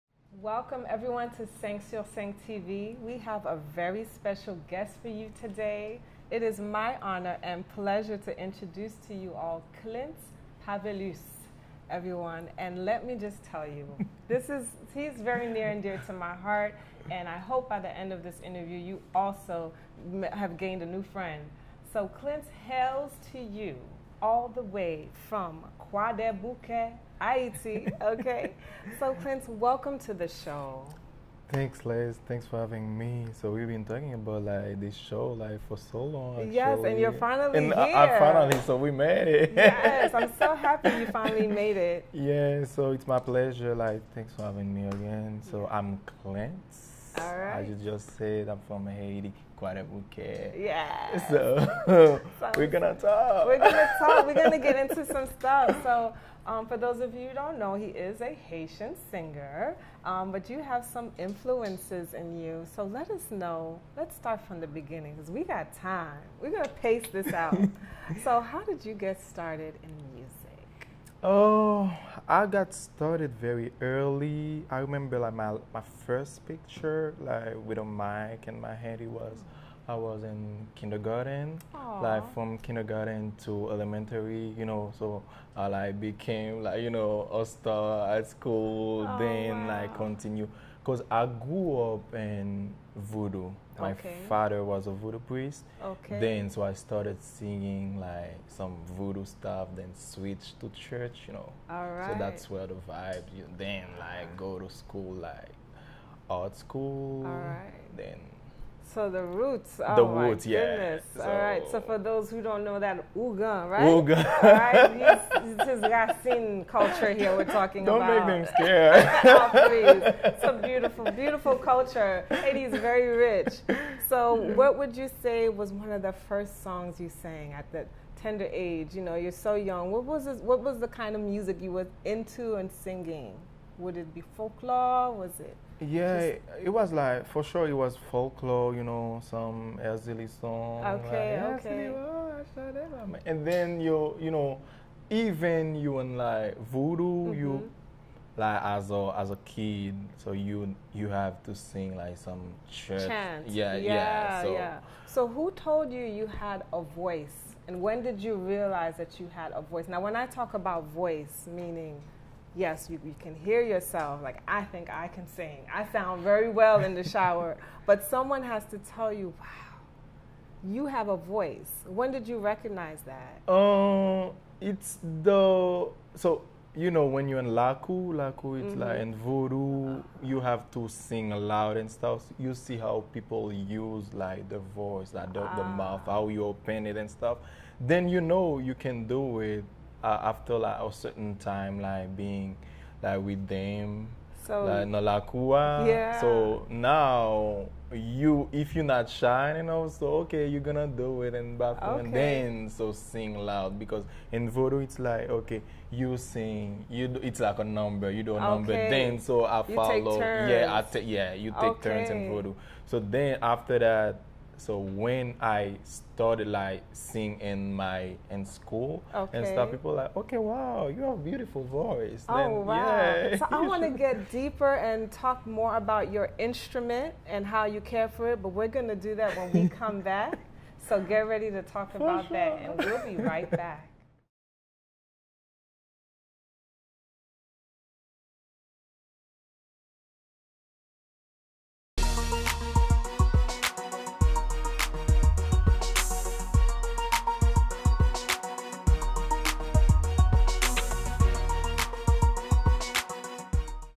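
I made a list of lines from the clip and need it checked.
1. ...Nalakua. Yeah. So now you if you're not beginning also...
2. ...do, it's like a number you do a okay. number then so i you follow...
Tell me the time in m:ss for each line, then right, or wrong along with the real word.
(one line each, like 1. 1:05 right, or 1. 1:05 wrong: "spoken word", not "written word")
1. 3:14 wrong: "shining", not "beginning"
2. 3:27 right.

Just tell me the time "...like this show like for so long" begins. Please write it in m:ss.
0:34.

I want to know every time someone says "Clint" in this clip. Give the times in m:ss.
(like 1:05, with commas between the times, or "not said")
0:09, 0:22, 0:29, 0:46.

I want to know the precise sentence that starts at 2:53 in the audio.
Uh, it's the, so, you know, when you're in Laku, Laku, it's mm -hmm.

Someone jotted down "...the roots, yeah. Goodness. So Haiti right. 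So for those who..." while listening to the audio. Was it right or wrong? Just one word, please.
wrong.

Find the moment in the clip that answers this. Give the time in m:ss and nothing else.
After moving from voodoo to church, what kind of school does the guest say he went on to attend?
1:46.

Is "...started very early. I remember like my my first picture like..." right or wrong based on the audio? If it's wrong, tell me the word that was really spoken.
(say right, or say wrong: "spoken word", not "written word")
right.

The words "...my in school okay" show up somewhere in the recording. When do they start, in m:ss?
3:37.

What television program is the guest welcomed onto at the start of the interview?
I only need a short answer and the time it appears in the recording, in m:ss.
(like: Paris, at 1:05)
Cinq Sur Cinq TV, at 0:01.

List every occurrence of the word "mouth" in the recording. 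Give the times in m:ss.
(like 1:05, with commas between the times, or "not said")
3:05.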